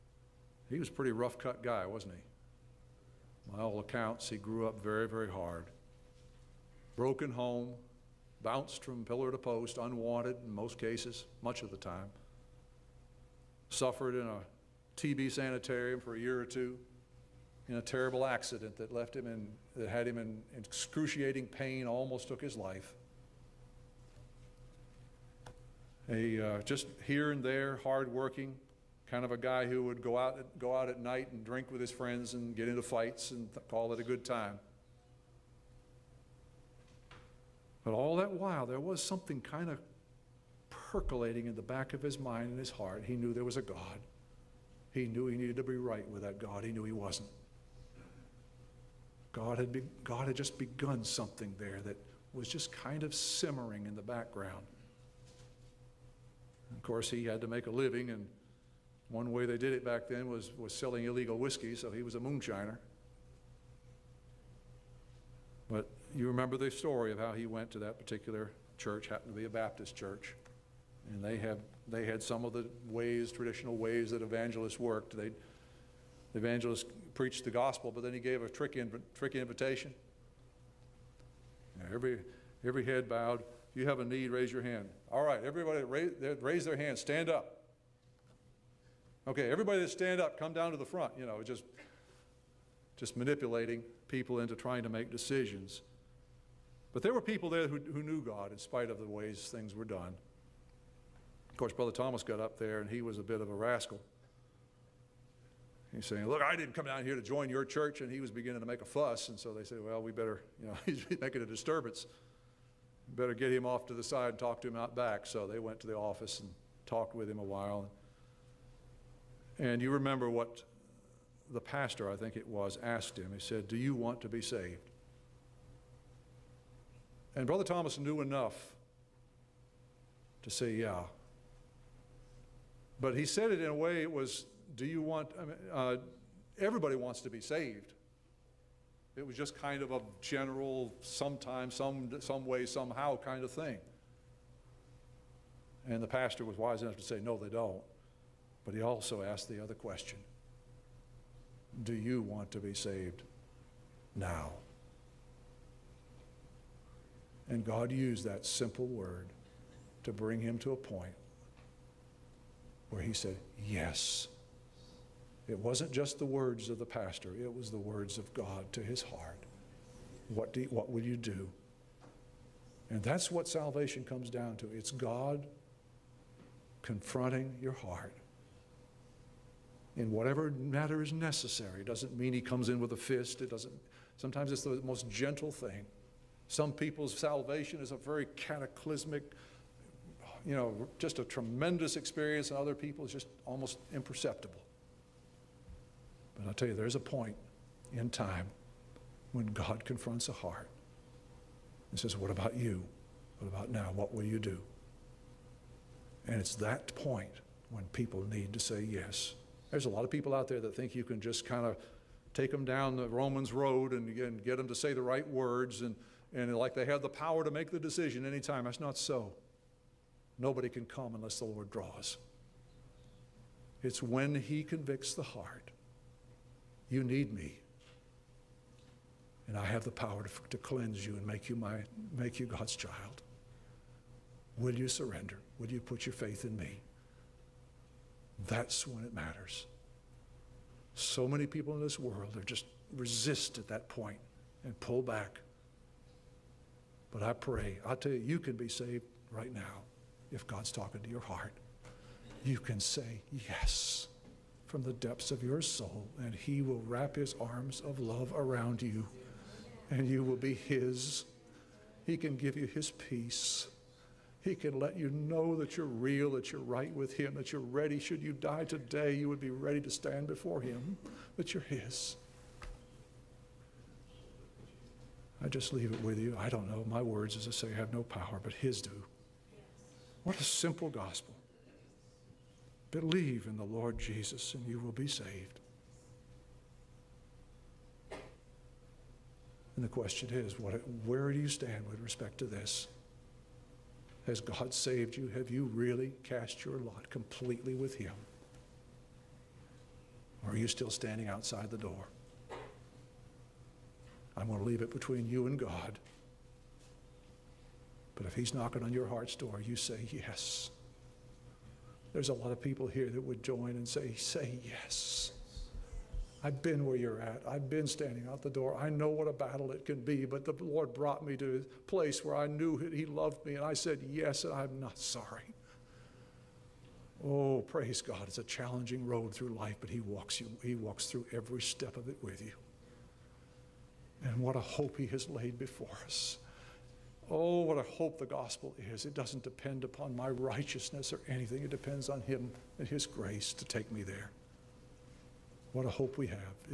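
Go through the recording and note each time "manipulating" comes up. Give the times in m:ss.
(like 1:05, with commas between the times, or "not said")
1:33.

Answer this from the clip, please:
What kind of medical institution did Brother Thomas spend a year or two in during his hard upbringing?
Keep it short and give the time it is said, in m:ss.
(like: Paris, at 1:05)
TB sanitarium, at 0:14.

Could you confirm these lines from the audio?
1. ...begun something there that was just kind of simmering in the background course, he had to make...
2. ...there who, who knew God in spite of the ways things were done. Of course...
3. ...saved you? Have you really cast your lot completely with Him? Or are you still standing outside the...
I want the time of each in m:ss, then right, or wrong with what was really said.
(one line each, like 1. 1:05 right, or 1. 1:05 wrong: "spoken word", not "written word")
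1. 0:50 right
2. 1:37 right
3. 4:54 right.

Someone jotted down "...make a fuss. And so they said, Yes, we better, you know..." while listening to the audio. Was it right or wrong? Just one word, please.
wrong.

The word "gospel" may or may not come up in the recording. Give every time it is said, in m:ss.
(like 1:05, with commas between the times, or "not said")
1:17, 4:40, 5:38.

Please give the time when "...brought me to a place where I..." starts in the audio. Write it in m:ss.
5:20.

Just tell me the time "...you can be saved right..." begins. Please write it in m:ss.
4:08.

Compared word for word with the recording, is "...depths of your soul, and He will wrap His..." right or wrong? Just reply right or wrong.
right.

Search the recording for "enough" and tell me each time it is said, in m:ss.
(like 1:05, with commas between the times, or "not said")
2:08, 2:26.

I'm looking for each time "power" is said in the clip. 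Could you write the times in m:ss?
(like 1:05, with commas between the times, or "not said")
3:37, 3:49, 4:38.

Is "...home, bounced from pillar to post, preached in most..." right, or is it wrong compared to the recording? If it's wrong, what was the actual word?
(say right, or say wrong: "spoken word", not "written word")
wrong: "unwanted", not "preached".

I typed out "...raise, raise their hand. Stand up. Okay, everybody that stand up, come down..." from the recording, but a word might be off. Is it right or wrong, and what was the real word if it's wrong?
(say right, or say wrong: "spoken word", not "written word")
right.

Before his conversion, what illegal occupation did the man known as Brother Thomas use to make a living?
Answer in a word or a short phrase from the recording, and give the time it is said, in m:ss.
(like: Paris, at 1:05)
moonshiner, at 1:02.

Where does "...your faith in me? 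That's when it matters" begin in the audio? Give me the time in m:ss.
3:56.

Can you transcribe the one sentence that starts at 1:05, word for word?
But you remember the story of how he went to that particular church, happened to be a Baptist church.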